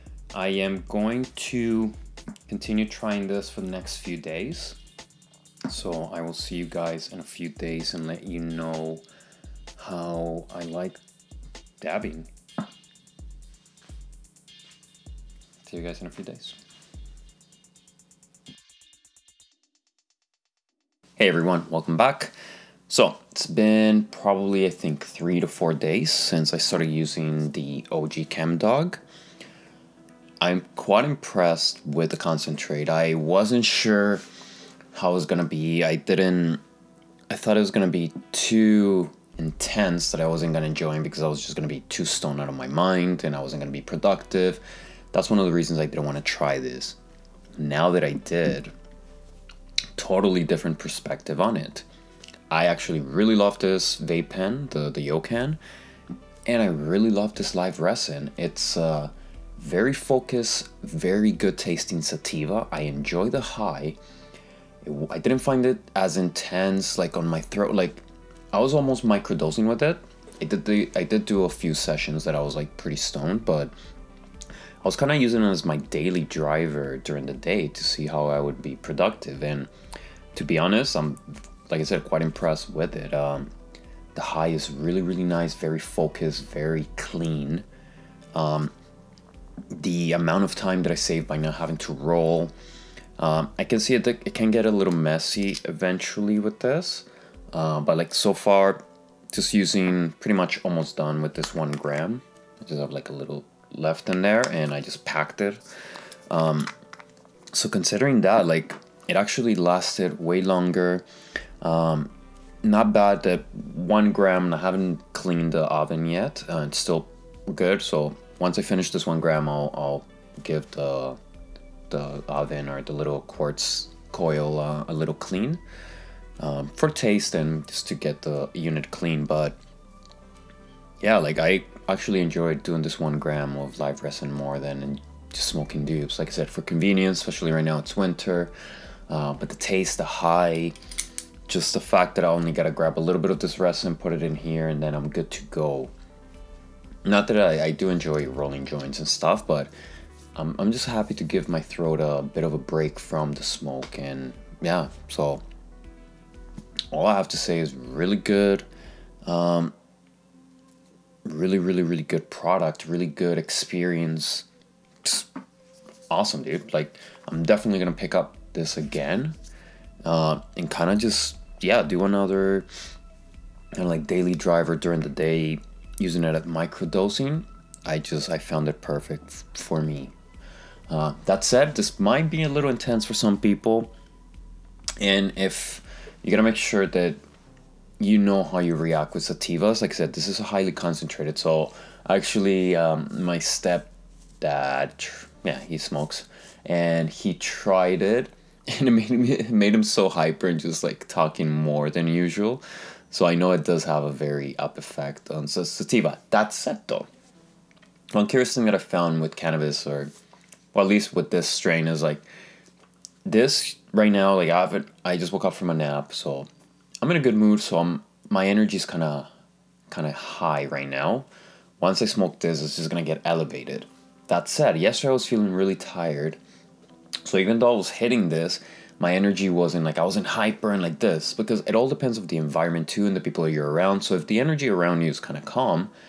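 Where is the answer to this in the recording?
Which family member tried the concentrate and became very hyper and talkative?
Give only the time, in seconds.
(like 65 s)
193 s.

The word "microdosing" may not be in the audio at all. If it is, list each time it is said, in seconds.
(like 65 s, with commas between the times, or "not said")
69 s, 176 s.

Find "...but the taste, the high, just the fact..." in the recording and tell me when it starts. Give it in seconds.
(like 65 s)
139 s.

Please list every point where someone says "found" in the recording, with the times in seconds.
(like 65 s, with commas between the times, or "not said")
178 s, 208 s.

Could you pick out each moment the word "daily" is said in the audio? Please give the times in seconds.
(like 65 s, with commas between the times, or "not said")
75 s, 174 s.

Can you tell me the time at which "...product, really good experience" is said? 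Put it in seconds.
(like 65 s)
162 s.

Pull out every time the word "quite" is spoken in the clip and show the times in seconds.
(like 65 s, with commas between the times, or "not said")
30 s, 82 s.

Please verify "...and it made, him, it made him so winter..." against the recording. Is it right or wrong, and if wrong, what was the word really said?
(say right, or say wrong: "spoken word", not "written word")
wrong: "hyper", not "winter".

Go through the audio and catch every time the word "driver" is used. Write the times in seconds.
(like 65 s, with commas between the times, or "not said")
76 s, 174 s.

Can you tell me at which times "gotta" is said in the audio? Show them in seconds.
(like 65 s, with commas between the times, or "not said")
142 s, 186 s.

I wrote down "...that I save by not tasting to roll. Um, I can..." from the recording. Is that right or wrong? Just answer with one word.
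wrong.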